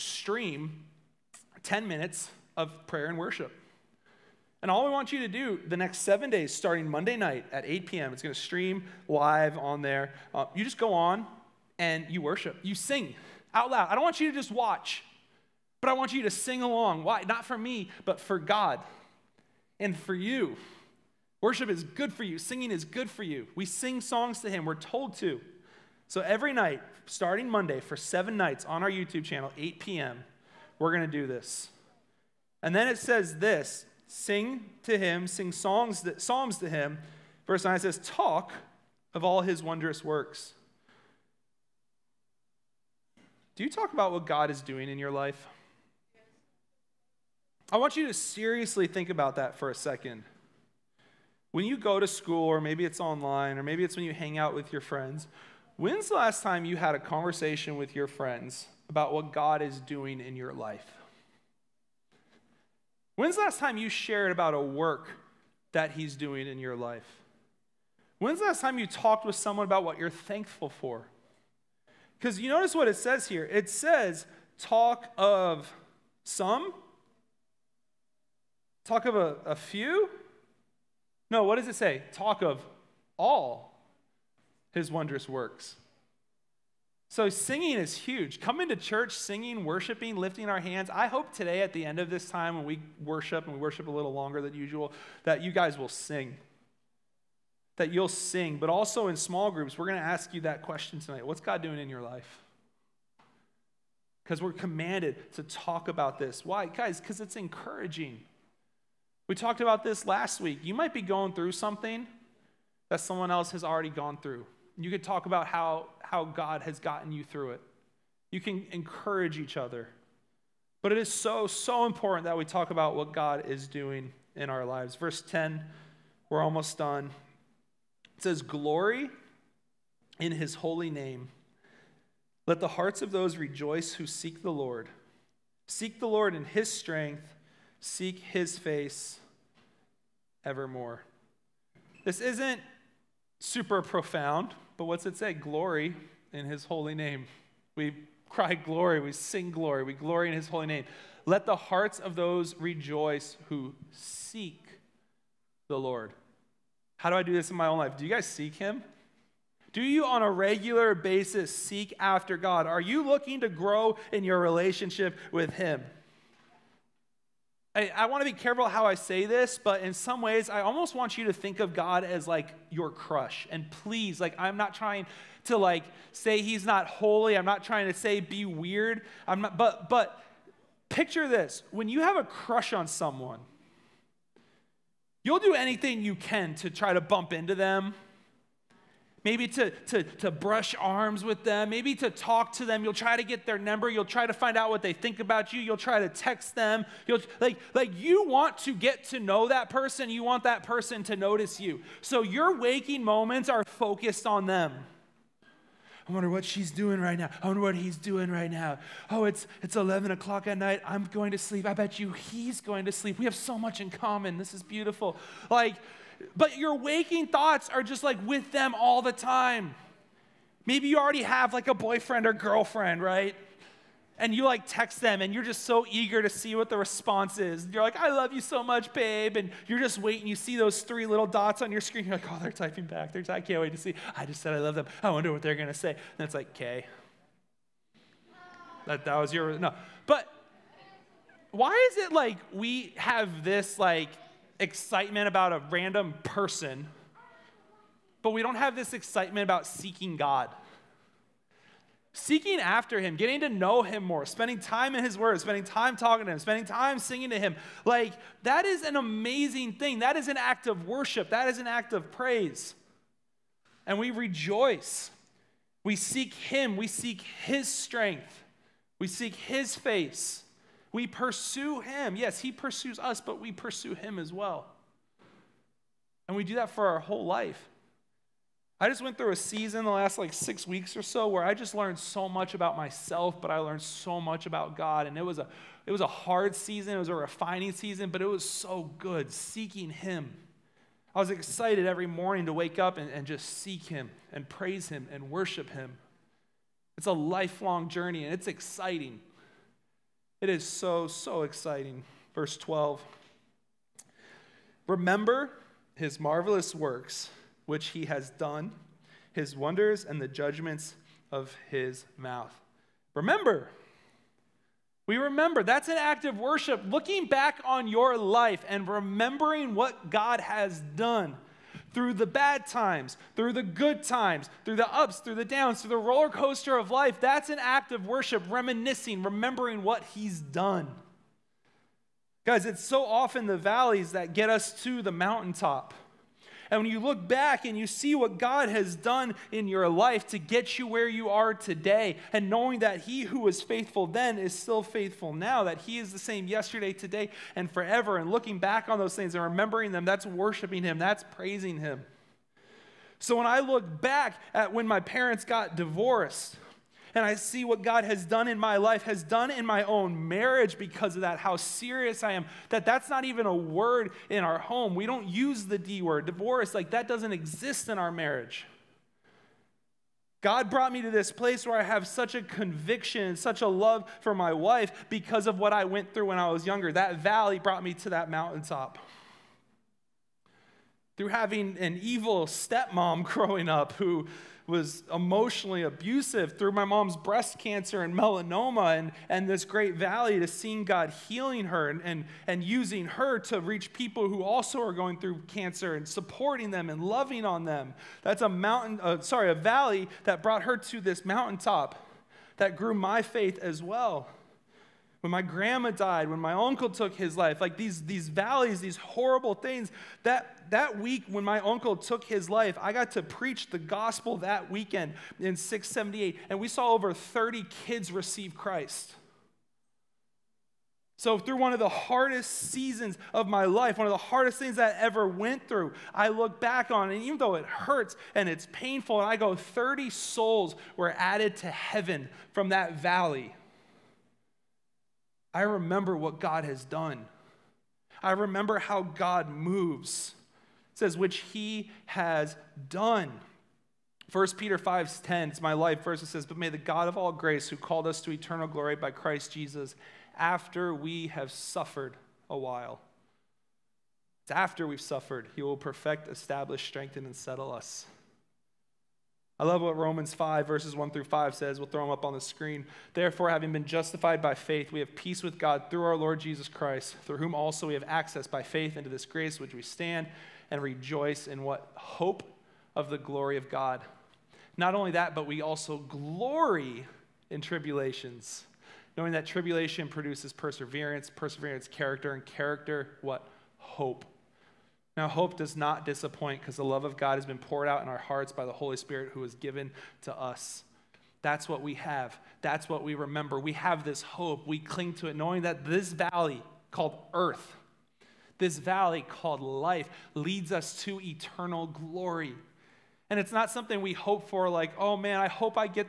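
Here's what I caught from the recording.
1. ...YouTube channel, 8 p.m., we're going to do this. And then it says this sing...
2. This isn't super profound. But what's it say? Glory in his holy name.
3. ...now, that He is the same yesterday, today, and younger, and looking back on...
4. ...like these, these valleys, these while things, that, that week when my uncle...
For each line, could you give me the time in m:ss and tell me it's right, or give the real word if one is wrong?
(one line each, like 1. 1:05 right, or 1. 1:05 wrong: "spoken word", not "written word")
1. 0:28 right
2. 2:22 right
3. 5:45 wrong: "forever", not "younger"
4. 6:47 wrong: "horrible", not "while".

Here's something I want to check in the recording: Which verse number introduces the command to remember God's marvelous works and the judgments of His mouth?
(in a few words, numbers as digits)
Verse 12.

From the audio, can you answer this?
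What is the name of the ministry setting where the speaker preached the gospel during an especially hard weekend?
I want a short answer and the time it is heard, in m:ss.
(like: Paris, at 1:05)
Six78, at 6:55.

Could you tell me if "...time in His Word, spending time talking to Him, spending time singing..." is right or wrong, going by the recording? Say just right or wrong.
right.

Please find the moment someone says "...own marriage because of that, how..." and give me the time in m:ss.
5:59.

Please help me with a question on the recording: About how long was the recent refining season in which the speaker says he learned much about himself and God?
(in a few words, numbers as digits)
6 weeks.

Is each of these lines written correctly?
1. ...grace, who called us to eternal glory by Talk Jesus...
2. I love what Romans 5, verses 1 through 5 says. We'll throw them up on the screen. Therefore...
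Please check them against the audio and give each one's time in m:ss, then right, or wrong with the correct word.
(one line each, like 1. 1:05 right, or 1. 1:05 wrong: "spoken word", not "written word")
1. 7:27 wrong: "Christ", not "Talk"
2. 7:39 right.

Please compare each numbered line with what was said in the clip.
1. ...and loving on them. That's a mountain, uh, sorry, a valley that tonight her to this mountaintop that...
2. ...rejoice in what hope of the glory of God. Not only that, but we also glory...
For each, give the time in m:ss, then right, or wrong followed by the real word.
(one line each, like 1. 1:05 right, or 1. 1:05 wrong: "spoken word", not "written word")
1. 6:36 wrong: "brought", not "tonight"
2. 7:50 right.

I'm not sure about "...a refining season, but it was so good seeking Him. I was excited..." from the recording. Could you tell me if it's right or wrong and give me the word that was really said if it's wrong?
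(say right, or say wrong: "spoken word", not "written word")
right.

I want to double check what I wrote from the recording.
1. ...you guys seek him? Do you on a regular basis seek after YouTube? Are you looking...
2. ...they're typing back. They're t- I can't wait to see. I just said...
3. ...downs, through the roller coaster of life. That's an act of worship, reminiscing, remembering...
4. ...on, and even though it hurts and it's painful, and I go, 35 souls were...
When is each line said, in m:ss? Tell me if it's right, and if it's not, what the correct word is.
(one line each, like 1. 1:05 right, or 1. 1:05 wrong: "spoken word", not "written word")
1. 2:38 wrong: "God", not "YouTube"
2. 3:52 right
3. 5:25 right
4. 7:06 wrong: "30", not "35".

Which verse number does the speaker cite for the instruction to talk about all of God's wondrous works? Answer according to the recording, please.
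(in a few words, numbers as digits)
Verse 9.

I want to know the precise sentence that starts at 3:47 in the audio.
You're like, I love you so much, babe.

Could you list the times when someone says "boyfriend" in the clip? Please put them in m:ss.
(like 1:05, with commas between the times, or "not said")
3:41.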